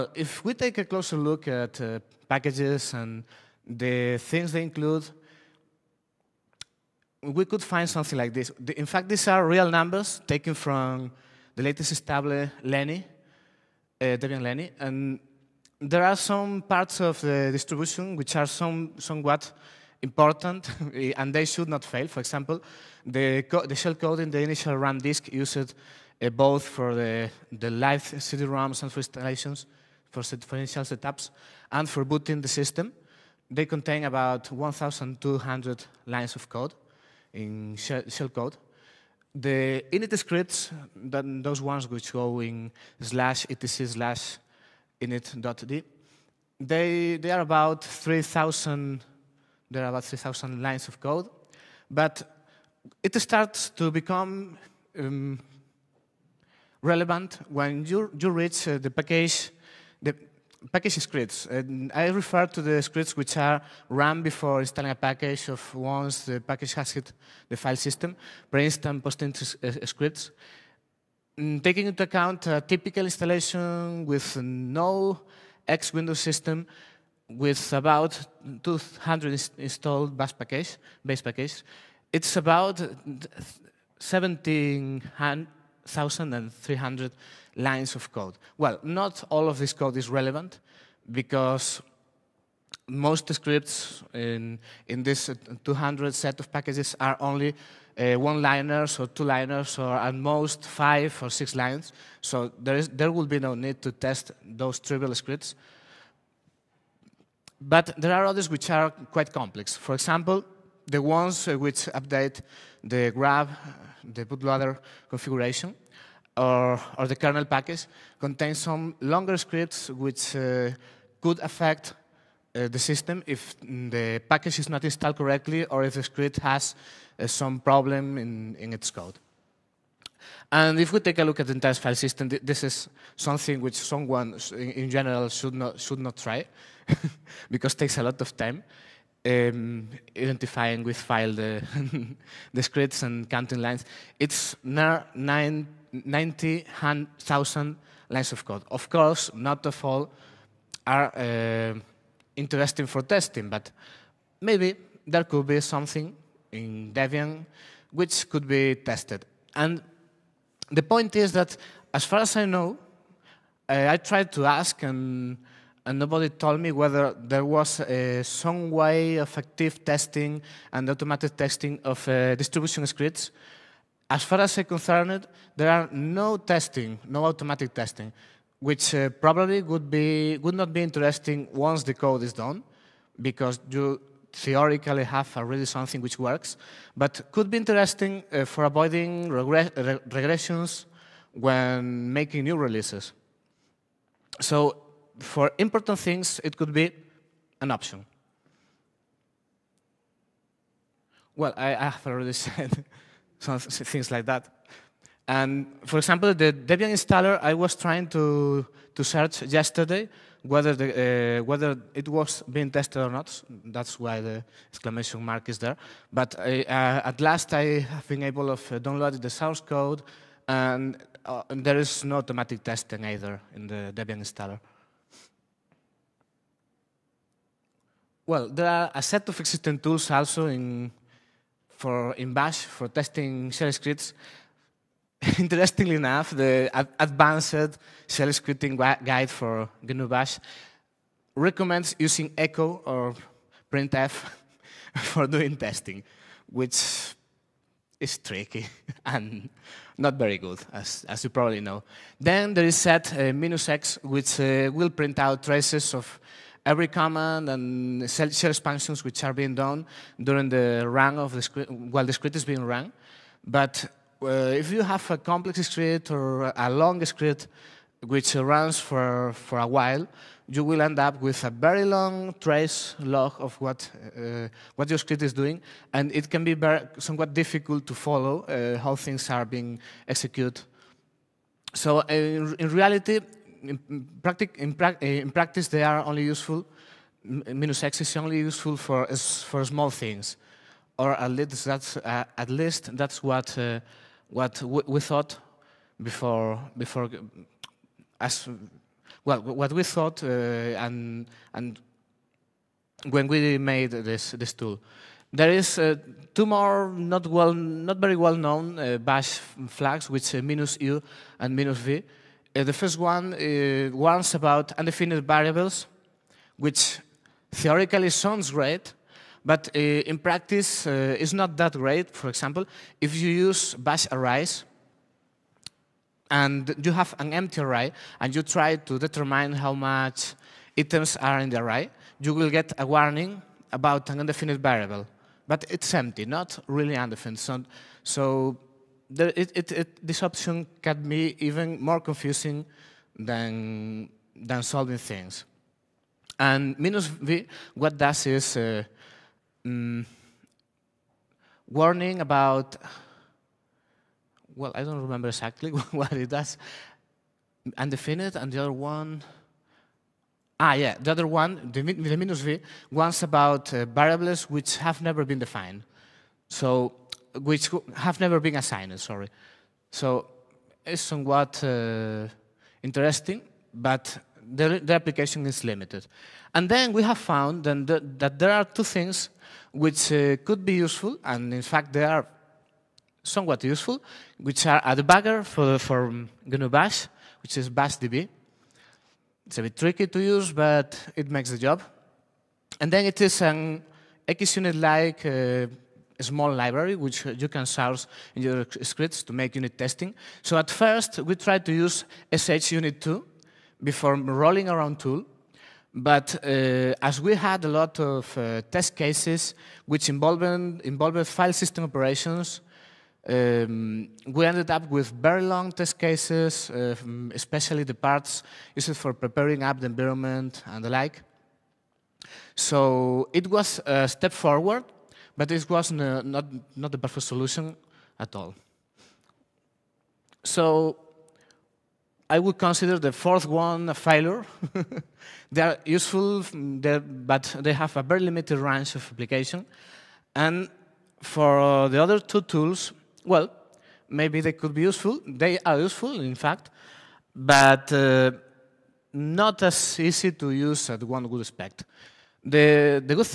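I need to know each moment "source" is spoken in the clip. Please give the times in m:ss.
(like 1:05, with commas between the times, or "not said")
3:39, 6:37.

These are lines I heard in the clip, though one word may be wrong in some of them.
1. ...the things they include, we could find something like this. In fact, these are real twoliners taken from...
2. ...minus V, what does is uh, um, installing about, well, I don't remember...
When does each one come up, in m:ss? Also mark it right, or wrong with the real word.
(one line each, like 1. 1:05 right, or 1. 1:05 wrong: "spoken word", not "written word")
1. 0:03 wrong: "numbers", not "twoliners"
2. 5:46 wrong: "warning", not "installing".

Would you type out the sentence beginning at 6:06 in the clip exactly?
So which have never been assigned, sorry.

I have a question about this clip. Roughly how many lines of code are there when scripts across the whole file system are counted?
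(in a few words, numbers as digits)
90,000.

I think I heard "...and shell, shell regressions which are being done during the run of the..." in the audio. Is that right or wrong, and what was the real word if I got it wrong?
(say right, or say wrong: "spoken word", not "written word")
wrong: "expansions", not "regressions".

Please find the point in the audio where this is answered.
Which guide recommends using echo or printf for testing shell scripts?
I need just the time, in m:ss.
3:56.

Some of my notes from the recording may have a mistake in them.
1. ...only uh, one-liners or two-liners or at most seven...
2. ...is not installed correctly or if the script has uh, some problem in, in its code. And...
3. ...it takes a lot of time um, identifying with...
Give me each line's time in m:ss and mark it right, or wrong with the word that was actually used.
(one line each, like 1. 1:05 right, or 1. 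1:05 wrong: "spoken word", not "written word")
1. 1:37 wrong: "five", not "seven"
2. 2:04 right
3. 2:17 right.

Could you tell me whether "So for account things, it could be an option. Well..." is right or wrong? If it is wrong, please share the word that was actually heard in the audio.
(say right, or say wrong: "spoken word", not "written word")
wrong: "important", not "account".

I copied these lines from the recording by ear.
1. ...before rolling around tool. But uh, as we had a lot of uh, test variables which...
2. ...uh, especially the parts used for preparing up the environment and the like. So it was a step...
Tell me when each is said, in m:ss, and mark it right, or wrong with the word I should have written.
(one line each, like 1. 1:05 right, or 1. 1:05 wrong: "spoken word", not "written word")
1. 6:43 wrong: "cases", not "variables"
2. 6:56 right.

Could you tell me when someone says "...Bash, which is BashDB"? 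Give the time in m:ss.
6:26.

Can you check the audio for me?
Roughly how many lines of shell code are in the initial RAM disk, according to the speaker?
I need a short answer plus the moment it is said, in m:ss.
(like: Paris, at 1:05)
1,200, at 0:34.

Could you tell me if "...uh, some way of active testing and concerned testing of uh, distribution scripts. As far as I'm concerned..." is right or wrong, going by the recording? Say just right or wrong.
wrong.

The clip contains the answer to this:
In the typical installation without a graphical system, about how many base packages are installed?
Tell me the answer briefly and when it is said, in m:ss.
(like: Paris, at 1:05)
200, at 1:17.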